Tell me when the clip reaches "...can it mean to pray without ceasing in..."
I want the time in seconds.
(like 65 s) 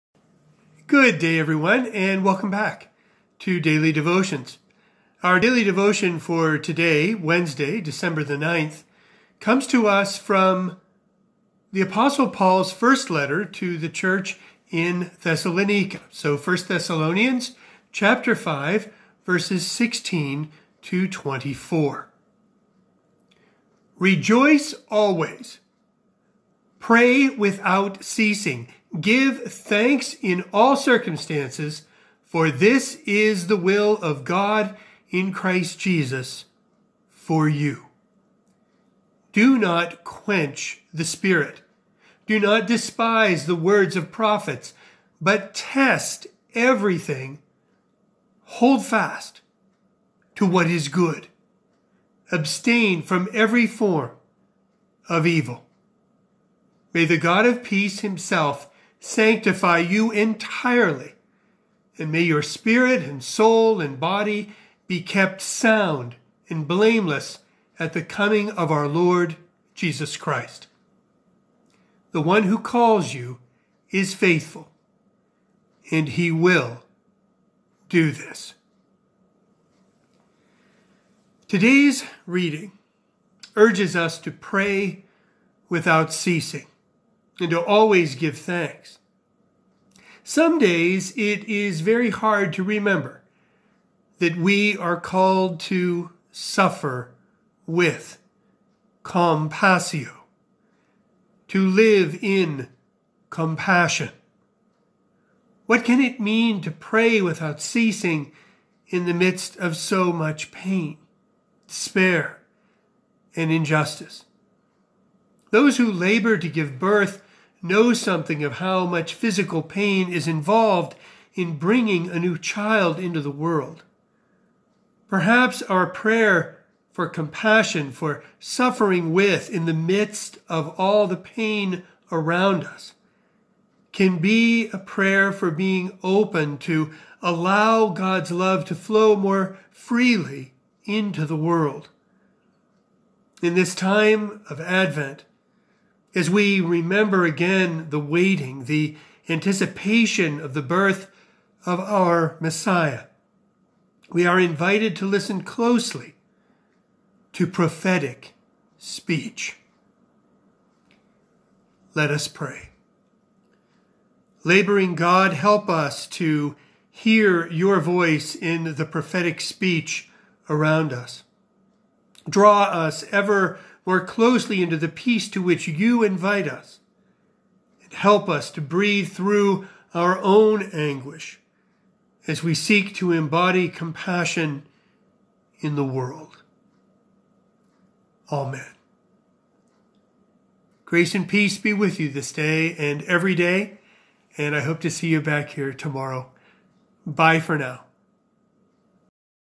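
105 s.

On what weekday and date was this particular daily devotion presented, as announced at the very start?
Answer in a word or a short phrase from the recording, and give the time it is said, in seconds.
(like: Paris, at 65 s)
Wednesday, December 9, at 7 s.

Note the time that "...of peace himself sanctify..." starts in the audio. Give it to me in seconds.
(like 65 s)
57 s.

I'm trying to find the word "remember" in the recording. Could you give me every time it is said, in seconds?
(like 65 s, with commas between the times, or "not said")
92 s, 146 s.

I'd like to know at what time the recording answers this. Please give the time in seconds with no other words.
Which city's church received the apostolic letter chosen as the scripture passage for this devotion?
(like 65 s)
15 s.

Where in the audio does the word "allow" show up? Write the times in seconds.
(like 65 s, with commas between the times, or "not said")
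137 s.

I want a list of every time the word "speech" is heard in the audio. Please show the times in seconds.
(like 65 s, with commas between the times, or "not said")
158 s, 169 s.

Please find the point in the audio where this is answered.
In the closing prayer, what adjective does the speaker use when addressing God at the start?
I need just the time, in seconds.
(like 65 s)
164 s.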